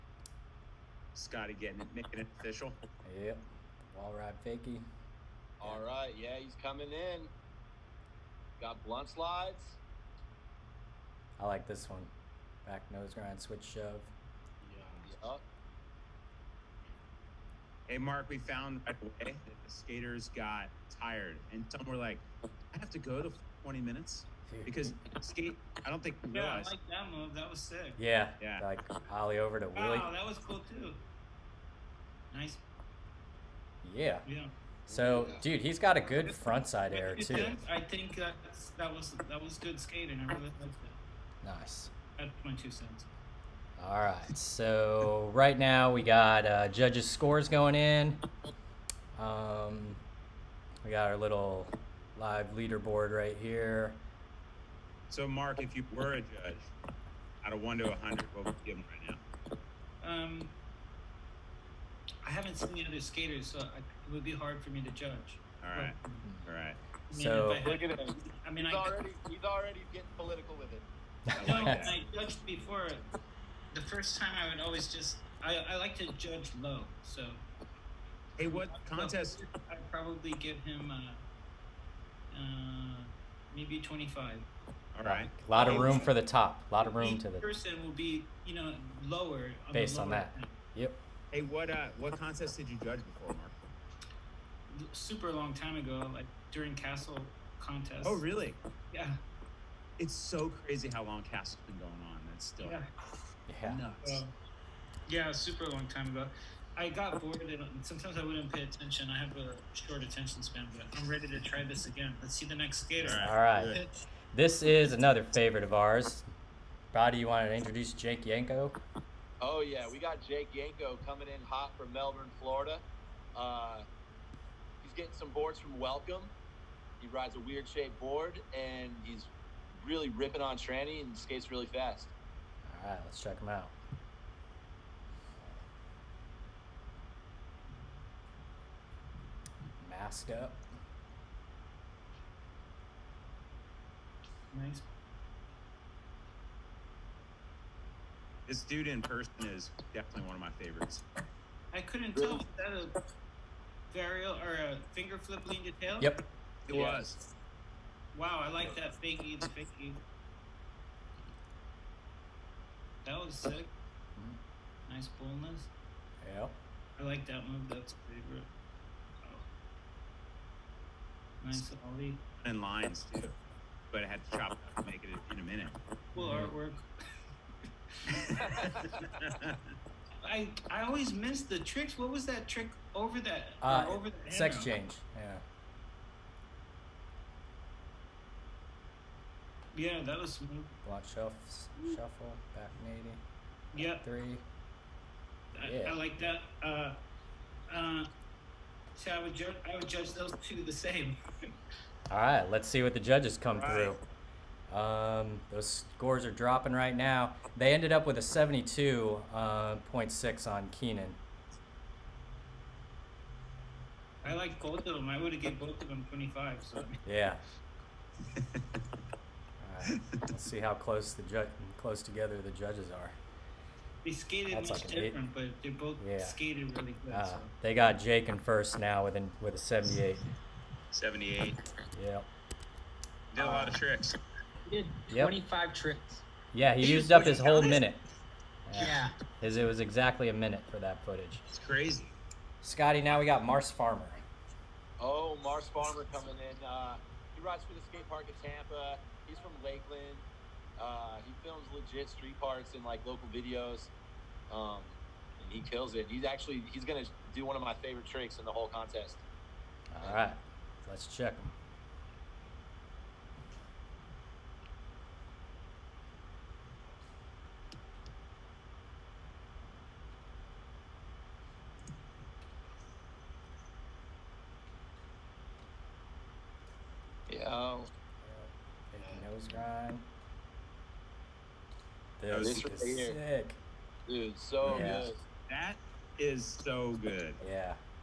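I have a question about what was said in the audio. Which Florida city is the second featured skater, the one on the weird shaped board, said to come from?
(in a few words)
Melbourne, Florida.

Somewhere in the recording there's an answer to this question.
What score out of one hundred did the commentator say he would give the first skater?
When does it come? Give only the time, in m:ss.
1:23.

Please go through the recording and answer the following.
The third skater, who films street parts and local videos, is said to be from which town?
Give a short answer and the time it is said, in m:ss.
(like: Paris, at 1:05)
Lakeland, at 4:09.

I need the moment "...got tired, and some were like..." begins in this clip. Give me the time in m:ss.
0:20.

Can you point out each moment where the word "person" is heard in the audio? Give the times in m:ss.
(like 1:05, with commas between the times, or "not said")
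1:27, 2:29.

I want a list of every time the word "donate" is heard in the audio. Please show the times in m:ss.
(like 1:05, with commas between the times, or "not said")
not said.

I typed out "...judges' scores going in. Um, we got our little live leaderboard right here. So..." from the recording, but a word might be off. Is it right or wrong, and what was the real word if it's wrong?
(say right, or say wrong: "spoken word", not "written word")
right.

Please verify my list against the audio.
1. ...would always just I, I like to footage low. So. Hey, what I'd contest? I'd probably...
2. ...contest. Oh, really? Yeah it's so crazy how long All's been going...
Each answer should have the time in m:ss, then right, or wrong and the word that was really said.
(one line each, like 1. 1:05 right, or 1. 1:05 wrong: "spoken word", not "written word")
1. 1:14 wrong: "judge", not "footage"
2. 1:37 wrong: "Castle", not "All".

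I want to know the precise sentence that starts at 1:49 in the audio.
I have a short attention span, but I'm ready to try this again.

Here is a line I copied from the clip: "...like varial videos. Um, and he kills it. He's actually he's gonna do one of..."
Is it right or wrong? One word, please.
wrong.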